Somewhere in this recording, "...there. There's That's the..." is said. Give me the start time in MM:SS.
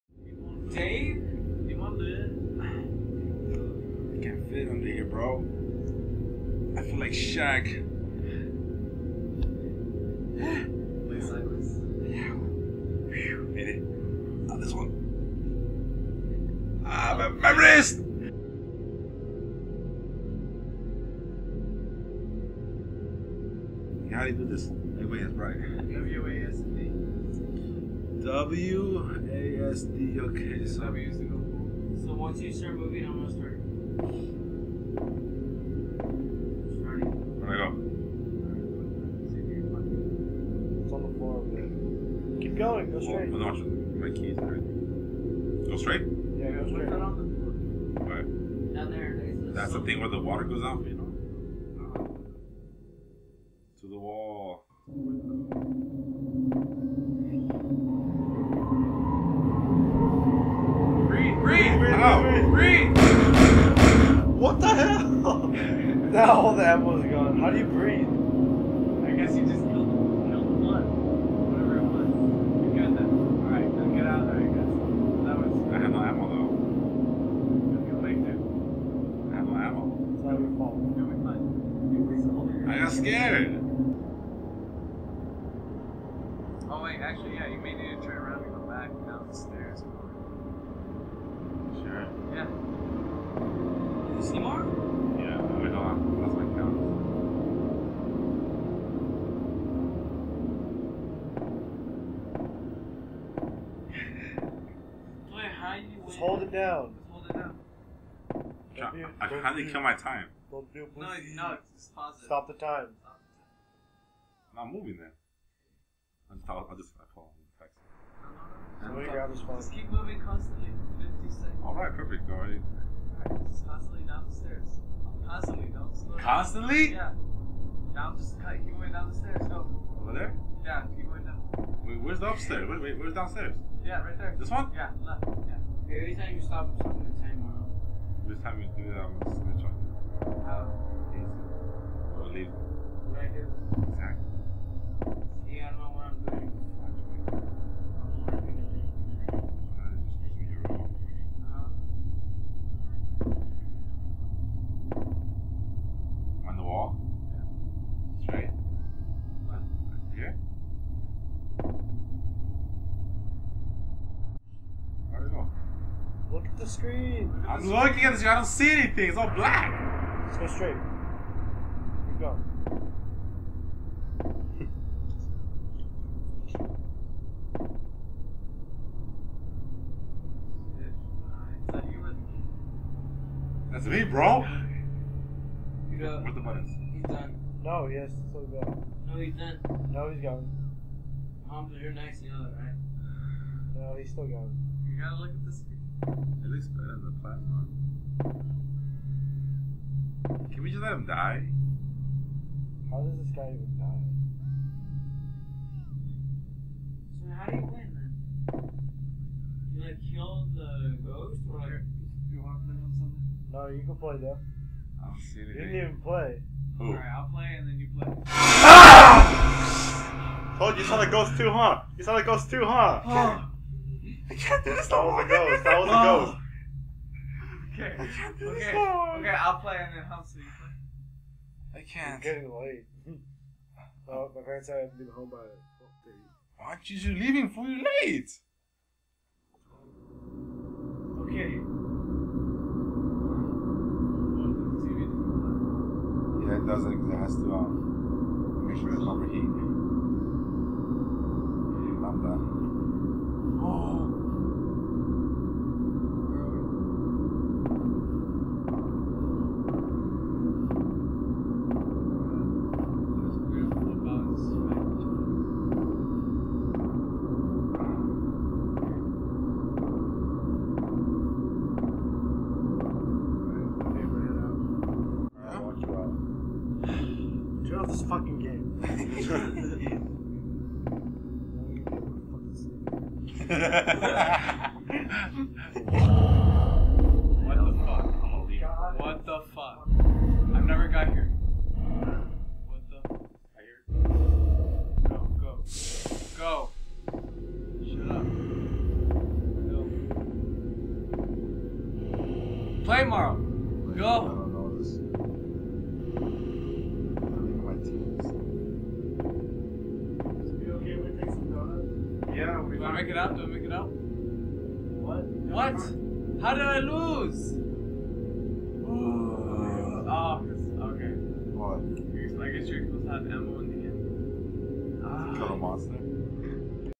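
00:48.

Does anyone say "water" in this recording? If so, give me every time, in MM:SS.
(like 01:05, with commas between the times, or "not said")
00:50.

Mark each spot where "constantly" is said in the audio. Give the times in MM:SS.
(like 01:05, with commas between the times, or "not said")
02:00, 02:06.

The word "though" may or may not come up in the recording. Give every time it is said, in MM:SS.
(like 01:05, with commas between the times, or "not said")
01:16, 03:34.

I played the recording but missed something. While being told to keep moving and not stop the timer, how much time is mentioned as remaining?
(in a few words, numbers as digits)
50 seconds.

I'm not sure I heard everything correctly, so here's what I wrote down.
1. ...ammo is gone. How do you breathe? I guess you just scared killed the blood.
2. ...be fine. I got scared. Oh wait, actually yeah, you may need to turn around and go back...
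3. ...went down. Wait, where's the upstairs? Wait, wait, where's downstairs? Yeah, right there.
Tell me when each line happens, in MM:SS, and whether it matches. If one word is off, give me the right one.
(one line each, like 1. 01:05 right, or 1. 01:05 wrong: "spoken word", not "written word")
1. 01:06 wrong: "killed", not "scared"
2. 01:21 right
3. 02:11 right.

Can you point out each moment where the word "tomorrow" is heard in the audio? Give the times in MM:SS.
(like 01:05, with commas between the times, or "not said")
05:02.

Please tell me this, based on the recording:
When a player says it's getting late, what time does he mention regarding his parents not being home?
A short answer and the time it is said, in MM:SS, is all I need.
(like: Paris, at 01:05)
12:30, at 03:55.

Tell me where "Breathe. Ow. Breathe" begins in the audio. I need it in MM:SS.
01:01.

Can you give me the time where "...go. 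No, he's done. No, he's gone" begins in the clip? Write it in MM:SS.
03:08.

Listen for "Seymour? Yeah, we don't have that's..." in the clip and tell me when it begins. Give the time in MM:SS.
01:34.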